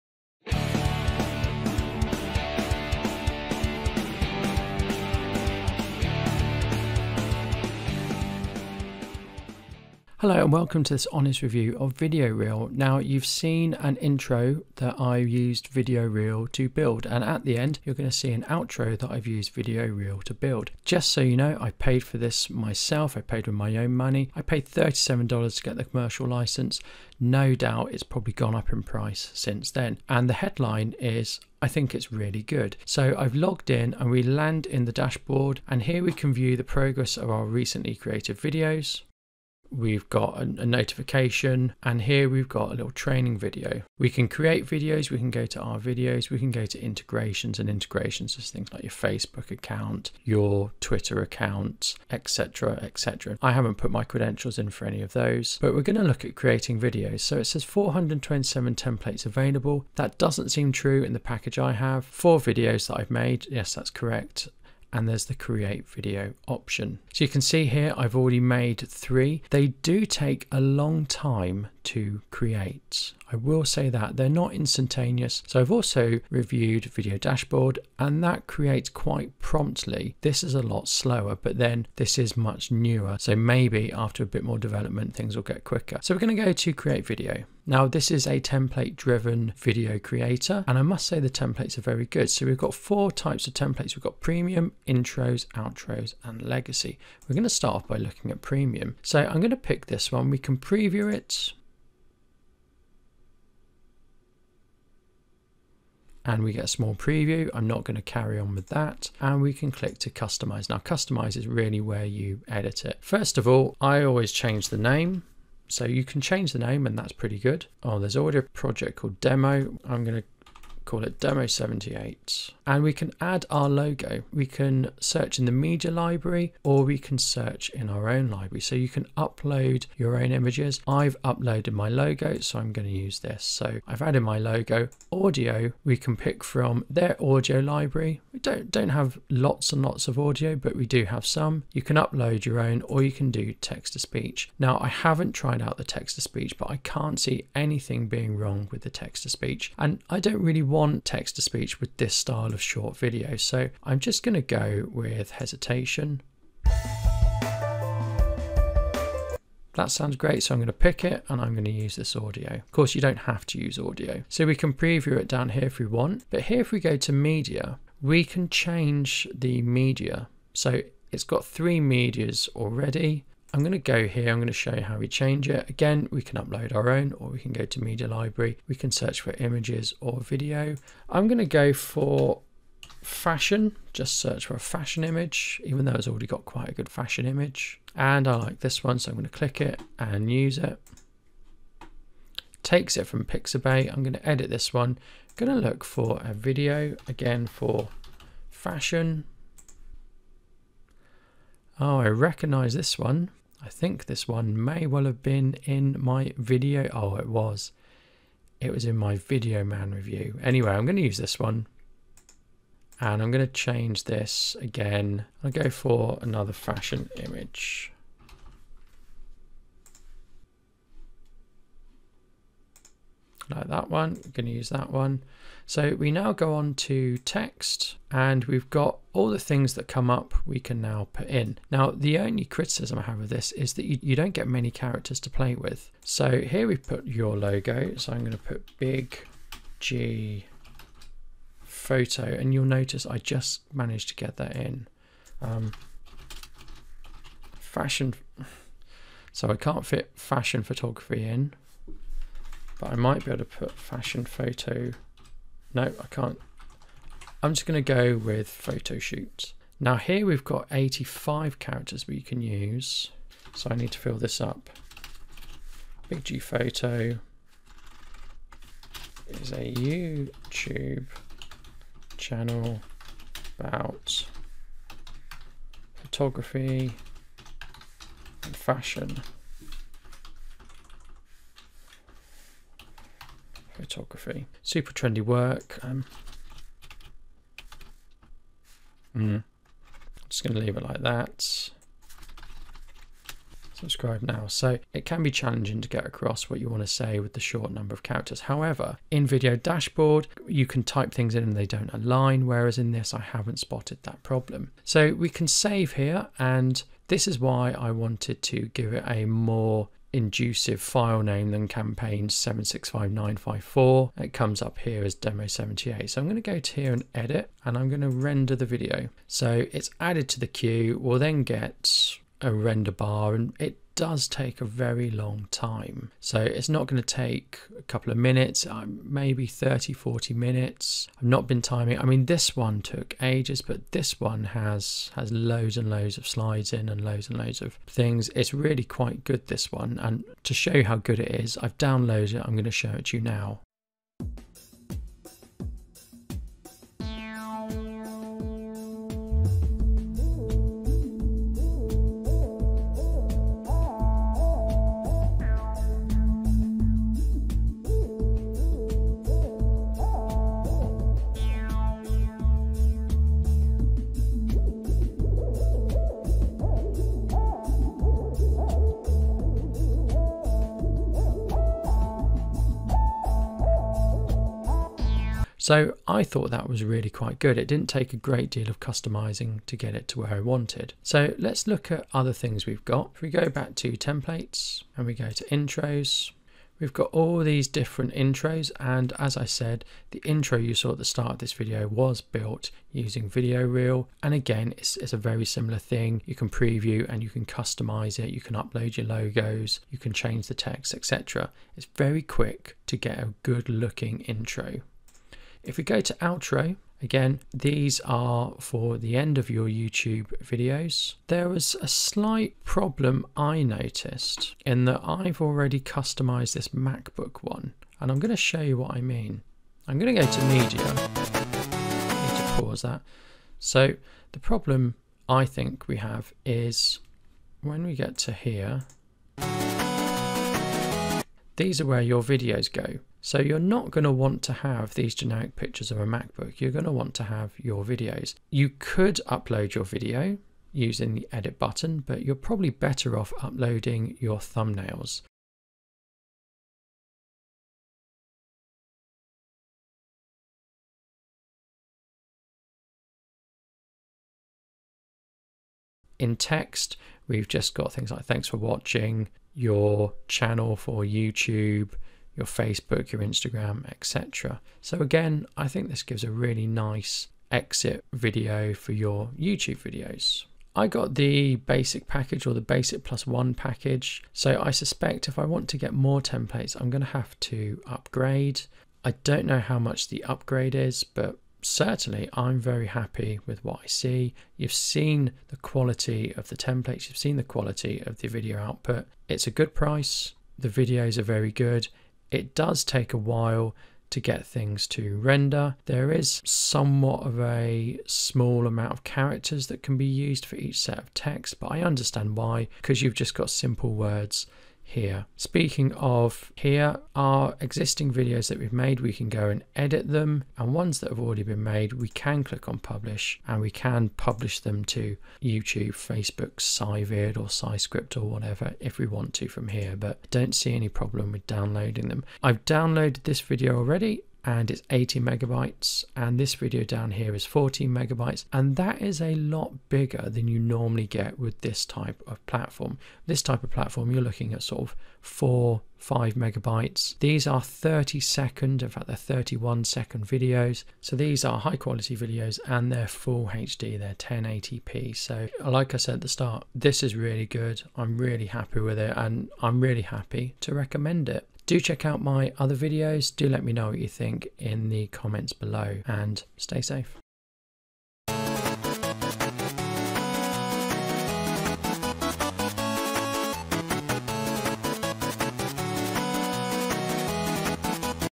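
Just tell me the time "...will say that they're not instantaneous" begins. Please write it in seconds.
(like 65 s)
73 s.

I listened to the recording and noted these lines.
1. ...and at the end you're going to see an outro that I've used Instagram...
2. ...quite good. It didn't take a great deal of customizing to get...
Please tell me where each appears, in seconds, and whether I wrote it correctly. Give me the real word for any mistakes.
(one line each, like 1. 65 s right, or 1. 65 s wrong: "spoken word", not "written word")
1. 17 s wrong: "Video", not "Instagram"
2. 377 s right.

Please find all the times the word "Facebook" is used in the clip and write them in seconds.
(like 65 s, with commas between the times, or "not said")
48 s, 462 s, 515 s.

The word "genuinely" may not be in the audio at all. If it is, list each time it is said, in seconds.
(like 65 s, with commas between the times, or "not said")
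not said.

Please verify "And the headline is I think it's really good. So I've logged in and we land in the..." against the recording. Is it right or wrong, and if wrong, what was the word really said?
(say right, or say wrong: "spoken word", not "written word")
right.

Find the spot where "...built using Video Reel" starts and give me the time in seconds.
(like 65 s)
392 s.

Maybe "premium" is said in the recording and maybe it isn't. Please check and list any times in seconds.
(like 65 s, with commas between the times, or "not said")
94 s, 98 s.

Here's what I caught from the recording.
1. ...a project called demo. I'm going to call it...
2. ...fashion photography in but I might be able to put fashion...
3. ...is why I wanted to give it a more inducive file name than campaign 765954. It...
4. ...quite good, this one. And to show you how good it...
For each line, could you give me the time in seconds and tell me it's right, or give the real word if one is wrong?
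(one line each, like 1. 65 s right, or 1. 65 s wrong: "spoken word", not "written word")
1. 118 s right
2. 250 s right
3. 307 s right
4. 338 s right.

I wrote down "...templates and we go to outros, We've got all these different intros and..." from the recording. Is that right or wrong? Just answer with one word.
wrong.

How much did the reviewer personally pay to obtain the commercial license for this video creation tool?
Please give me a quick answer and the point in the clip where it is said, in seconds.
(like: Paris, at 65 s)
$37, at 24 s.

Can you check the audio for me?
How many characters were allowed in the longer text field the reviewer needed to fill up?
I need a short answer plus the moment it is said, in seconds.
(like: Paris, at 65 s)
85, at 260 s.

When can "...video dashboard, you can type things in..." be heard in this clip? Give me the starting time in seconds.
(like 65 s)
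299 s.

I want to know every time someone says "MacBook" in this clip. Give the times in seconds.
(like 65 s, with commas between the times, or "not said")
416 s, 436 s.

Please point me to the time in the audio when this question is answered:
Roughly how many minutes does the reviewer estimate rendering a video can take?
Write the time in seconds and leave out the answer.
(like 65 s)
329 s.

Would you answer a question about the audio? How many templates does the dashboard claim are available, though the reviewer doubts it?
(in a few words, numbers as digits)
427.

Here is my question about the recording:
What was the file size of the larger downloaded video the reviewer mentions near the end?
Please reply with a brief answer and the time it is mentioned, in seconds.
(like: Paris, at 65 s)
80 megabytes, at 524 s.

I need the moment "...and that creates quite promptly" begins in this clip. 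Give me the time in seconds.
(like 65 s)
77 s.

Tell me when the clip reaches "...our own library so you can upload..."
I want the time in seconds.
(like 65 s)
127 s.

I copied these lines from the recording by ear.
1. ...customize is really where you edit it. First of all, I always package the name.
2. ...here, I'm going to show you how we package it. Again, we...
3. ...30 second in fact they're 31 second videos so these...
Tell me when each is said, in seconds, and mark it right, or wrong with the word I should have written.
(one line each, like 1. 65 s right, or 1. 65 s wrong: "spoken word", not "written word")
1. 110 s wrong: "change", not "package"
2. 174 s wrong: "change", not "package"
3. 537 s right.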